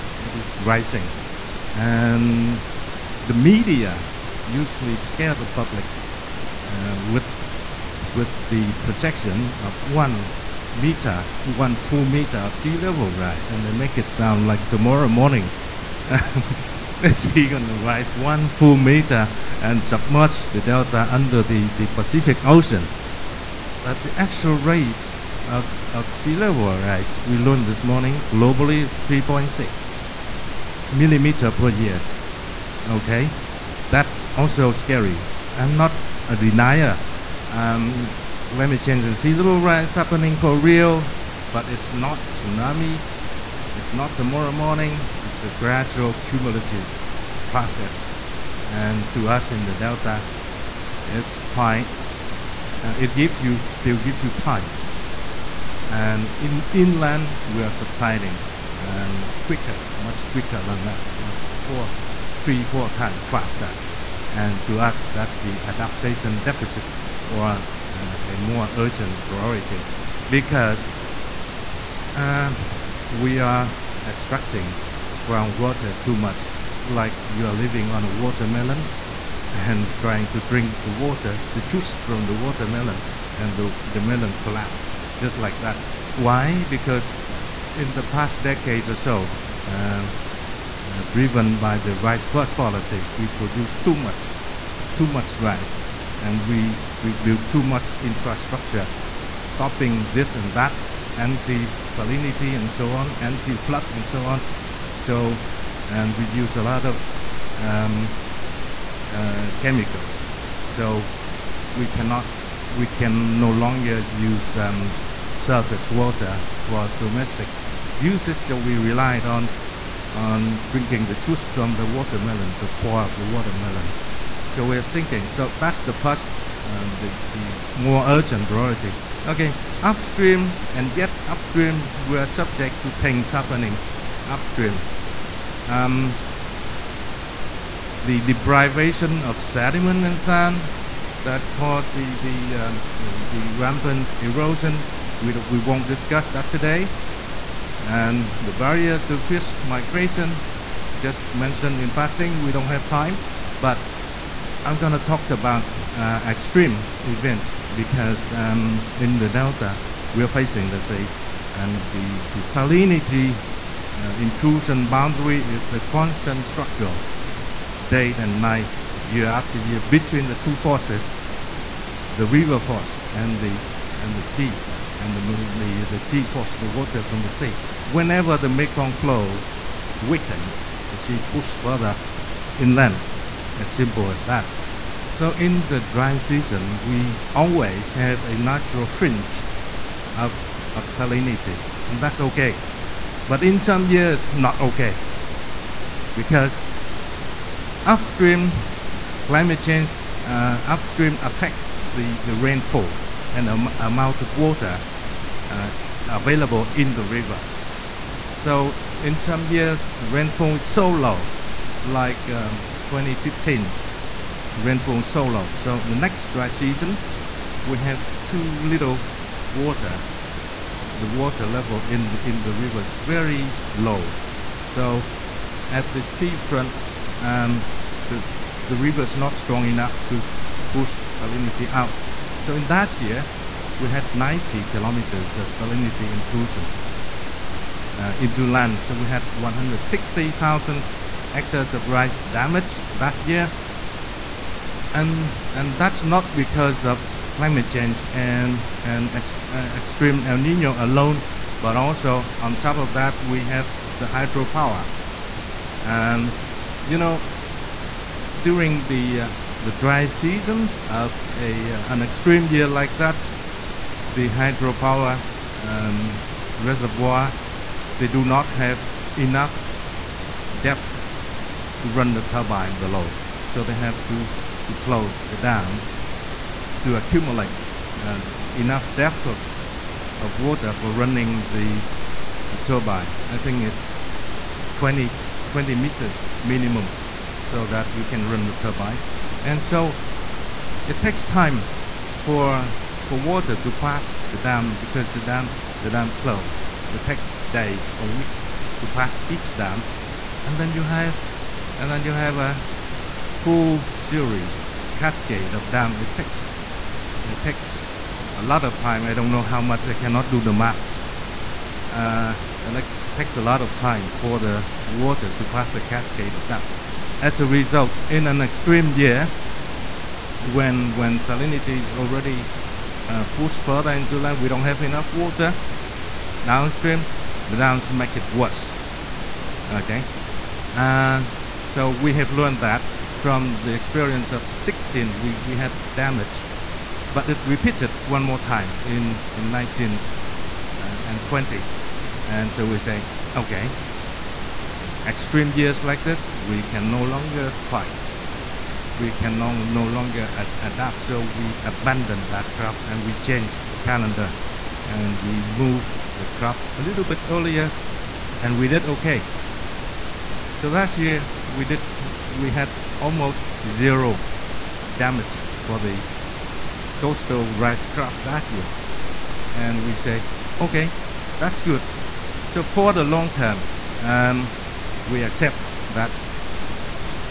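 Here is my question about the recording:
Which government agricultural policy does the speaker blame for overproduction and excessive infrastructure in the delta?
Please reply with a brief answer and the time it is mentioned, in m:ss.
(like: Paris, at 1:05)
Rice first policy, at 1:31.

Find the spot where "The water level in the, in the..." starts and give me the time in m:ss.
3:40.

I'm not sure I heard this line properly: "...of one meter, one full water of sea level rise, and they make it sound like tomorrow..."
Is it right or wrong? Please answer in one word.
wrong.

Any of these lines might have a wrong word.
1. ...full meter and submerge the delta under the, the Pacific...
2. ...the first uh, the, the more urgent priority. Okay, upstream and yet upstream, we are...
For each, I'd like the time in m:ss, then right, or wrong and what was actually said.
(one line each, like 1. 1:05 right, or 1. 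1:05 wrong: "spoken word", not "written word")
1. 0:18 right
2. 2:05 right.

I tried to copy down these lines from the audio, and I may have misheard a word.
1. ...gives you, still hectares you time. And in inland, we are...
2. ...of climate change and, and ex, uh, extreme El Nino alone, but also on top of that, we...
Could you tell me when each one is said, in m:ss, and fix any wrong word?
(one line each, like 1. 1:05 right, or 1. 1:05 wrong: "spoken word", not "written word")
1. 0:53 wrong: "gives", not "hectares"
2. 4:06 right.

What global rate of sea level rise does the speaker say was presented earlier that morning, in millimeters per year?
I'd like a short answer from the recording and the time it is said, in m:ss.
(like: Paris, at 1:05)
3.6 mm per year, at 0:29.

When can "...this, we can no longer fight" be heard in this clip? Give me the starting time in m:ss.
5:46.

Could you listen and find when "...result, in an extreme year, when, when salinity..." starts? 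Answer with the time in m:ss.
5:17.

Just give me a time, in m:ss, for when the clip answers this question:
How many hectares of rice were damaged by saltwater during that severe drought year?
3:59.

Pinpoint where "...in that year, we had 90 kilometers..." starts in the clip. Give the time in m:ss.
3:52.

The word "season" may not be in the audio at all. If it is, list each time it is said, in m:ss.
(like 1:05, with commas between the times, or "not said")
3:06, 3:36, 4:20.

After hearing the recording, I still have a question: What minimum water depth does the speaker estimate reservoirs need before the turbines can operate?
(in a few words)
20 meters.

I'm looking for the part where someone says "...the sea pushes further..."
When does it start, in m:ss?
3:00.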